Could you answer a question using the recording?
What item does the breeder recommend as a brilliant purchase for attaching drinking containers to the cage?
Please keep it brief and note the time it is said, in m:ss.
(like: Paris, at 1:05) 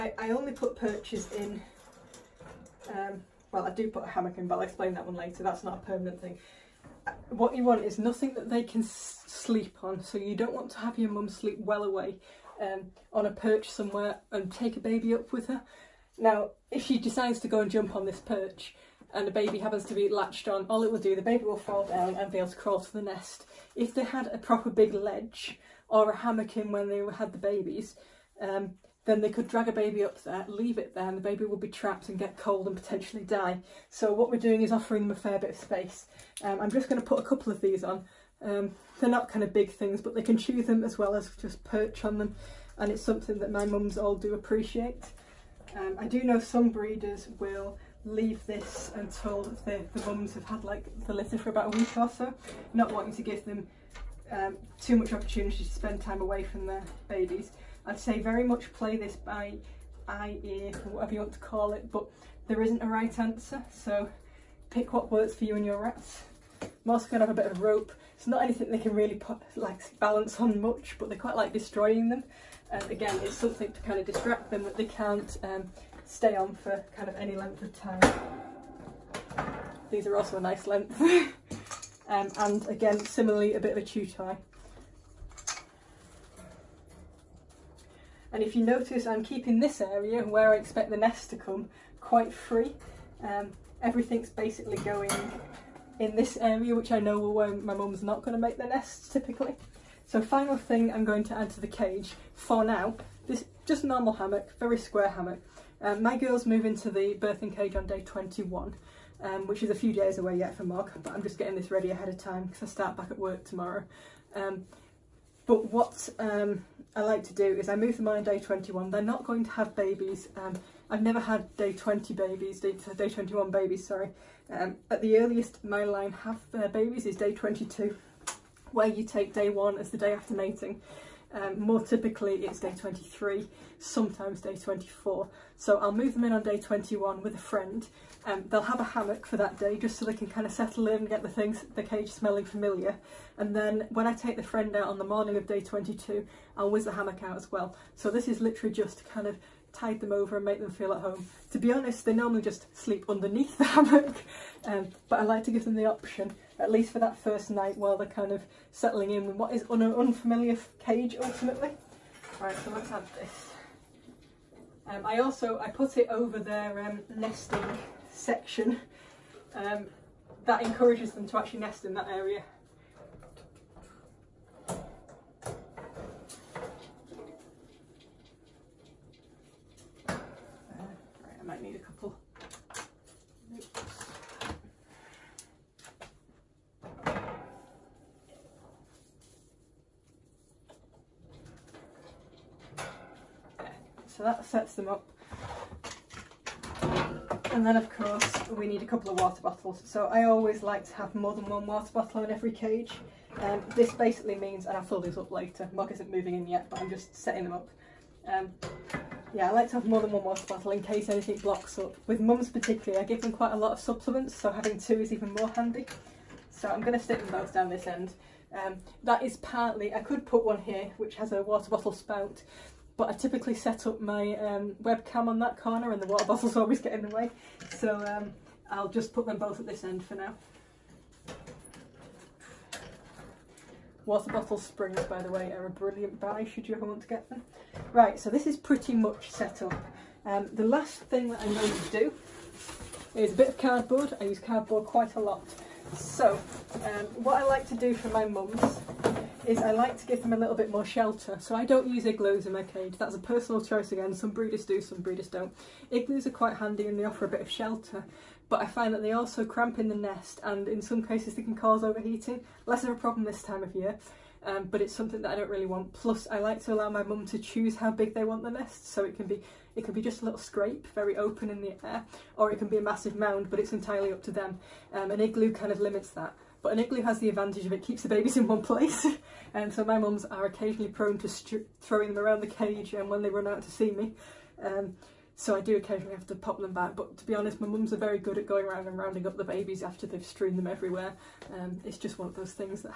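Bottle springs, at 3:54.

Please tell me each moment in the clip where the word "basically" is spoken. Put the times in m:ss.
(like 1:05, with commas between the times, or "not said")
1:34, 3:23.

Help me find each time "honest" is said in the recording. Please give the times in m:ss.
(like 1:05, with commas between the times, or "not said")
2:31, 4:47.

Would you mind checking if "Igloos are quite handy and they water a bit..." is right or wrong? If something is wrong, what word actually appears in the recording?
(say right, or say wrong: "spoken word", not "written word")
wrong: "offer", not "water".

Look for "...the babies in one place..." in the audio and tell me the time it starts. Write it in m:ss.
4:38.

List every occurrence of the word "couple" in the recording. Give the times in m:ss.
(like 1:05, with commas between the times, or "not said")
0:37, 3:01, 3:18.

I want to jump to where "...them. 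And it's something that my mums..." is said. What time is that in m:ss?
0:42.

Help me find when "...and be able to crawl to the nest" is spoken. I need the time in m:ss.
0:22.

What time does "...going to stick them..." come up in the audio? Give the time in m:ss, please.
3:36.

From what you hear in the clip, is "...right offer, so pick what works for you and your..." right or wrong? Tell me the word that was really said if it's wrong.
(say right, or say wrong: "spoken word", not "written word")
wrong: "answer", not "offer".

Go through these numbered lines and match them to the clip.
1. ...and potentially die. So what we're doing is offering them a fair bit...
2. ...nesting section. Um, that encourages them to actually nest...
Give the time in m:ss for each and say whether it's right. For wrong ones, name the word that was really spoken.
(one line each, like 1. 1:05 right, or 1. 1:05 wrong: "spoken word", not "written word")
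1. 0:32 right
2. 2:47 right.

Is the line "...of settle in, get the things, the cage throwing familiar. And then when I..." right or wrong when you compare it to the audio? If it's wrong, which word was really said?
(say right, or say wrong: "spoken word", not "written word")
wrong: "smelling", not "throwing".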